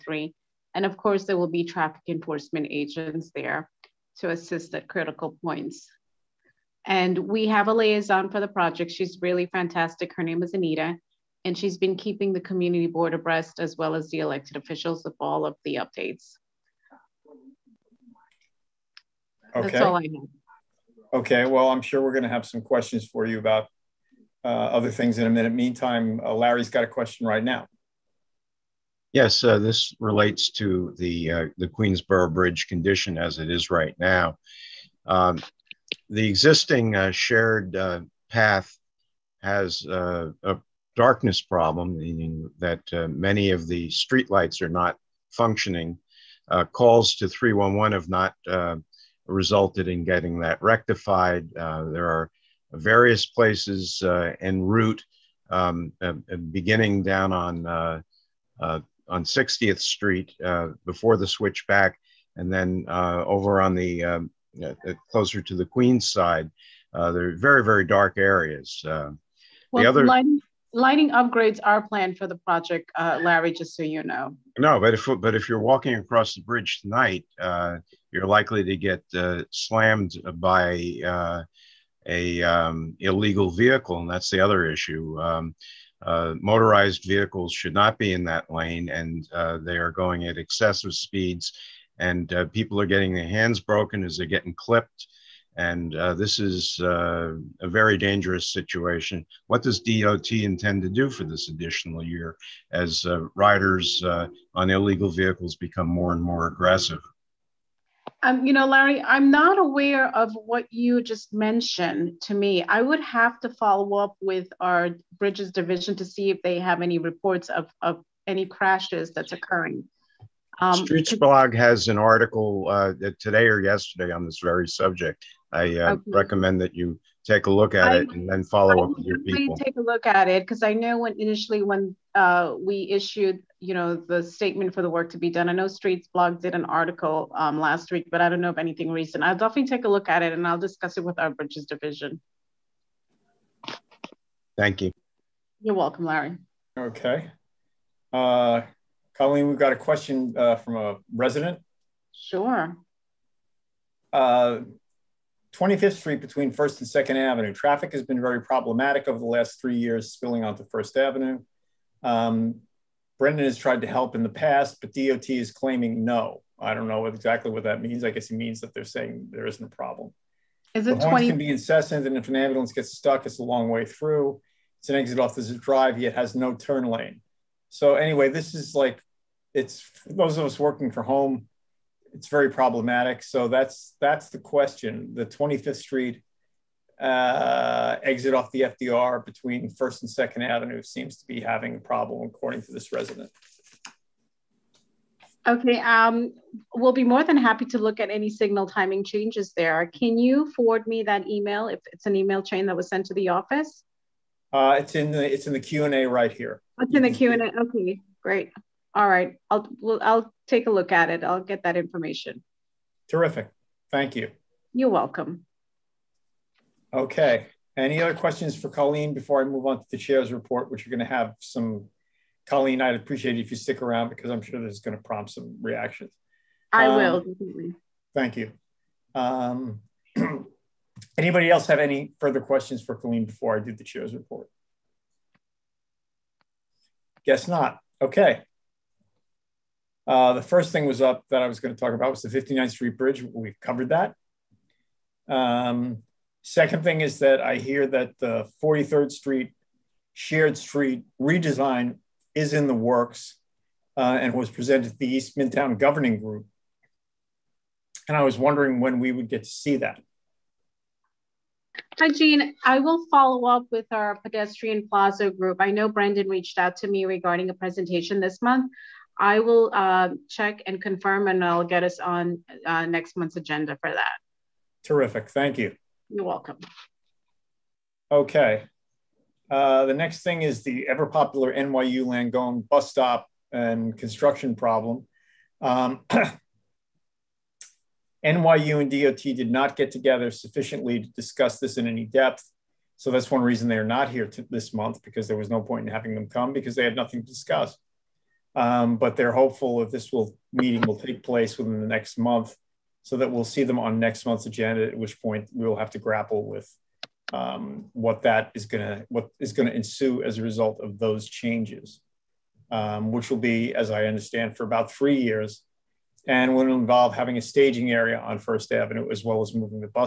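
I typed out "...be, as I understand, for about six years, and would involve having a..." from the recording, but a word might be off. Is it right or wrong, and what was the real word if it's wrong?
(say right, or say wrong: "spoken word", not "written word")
wrong: "three", not "six".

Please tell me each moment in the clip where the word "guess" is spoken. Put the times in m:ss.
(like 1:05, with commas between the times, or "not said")
2:48, 3:57.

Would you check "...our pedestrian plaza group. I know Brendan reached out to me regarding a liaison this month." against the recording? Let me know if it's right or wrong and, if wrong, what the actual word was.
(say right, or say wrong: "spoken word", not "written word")
wrong: "presentation", not "liaison".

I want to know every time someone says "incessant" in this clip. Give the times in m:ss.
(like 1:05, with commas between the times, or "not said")
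2:51.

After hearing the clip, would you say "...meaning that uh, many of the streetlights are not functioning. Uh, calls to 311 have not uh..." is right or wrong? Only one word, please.
right.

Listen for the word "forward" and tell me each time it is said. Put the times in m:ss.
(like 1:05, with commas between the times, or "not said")
3:20.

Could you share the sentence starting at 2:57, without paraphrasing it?
So anyway, this is like it's those of us working from home.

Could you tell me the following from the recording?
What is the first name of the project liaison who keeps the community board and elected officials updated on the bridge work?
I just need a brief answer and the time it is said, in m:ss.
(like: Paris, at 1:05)
Anita, at 0:10.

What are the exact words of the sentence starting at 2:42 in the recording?
Um, Brendan has tried to help in the past, but DOT is claiming no.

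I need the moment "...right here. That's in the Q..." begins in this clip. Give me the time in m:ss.
3:26.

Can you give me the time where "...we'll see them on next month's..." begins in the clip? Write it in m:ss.
5:03.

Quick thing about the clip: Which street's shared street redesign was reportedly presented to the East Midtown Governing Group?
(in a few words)
43rd Street.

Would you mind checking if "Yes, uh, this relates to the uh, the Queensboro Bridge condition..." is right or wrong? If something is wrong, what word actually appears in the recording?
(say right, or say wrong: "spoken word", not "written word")
right.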